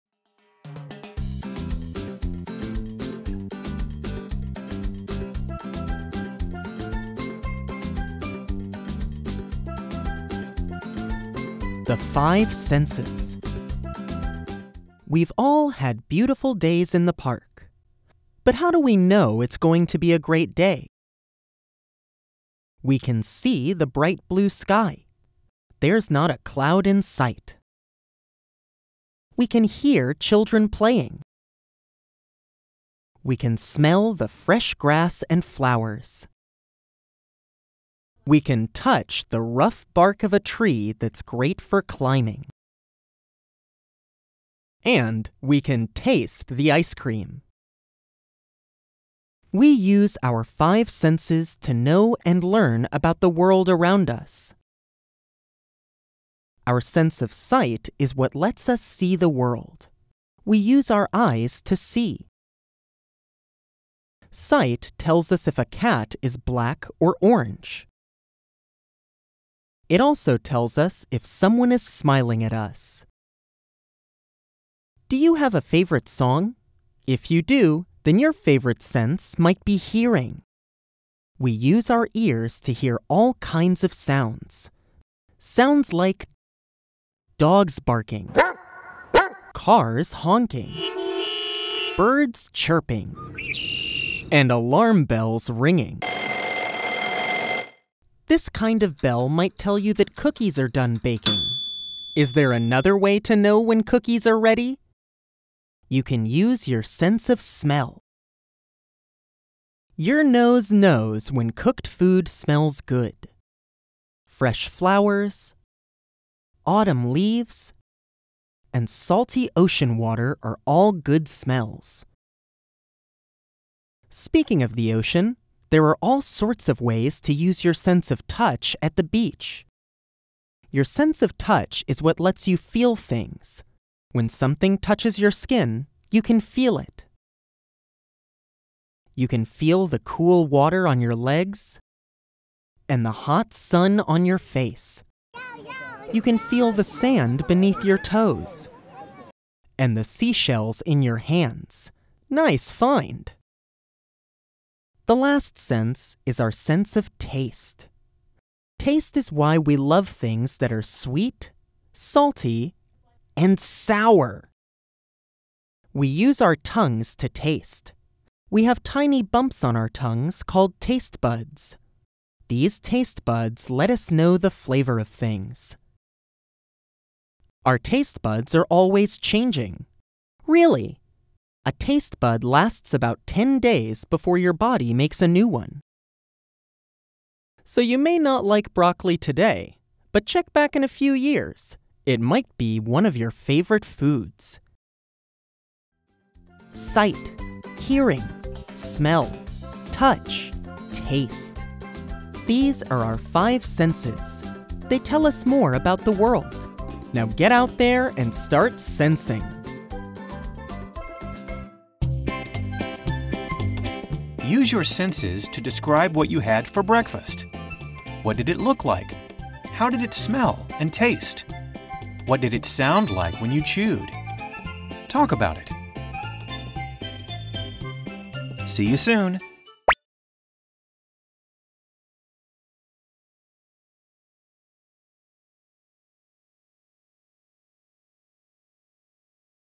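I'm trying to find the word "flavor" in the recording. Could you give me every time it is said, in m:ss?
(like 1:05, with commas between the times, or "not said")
2:54.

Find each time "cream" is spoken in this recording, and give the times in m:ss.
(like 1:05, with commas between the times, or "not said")
0:46.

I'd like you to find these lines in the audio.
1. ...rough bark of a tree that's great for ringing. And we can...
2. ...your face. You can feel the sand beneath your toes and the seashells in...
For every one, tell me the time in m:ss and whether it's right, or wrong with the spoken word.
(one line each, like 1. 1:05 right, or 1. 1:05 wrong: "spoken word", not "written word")
1. 0:39 wrong: "climbing", not "ringing"
2. 2:24 right.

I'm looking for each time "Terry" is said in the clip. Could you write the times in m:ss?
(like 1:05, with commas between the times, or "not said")
not said.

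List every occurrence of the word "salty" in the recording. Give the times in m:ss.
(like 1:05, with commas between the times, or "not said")
1:58, 2:41.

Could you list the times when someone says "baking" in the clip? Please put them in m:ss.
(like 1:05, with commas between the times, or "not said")
1:41.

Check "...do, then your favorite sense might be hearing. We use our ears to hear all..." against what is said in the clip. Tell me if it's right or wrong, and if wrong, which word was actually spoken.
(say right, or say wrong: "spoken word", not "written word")
right.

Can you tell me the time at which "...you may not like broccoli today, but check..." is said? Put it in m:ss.
3:07.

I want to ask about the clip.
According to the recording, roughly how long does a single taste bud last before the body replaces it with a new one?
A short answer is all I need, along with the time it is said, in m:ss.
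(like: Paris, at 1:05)
10 days, at 3:03.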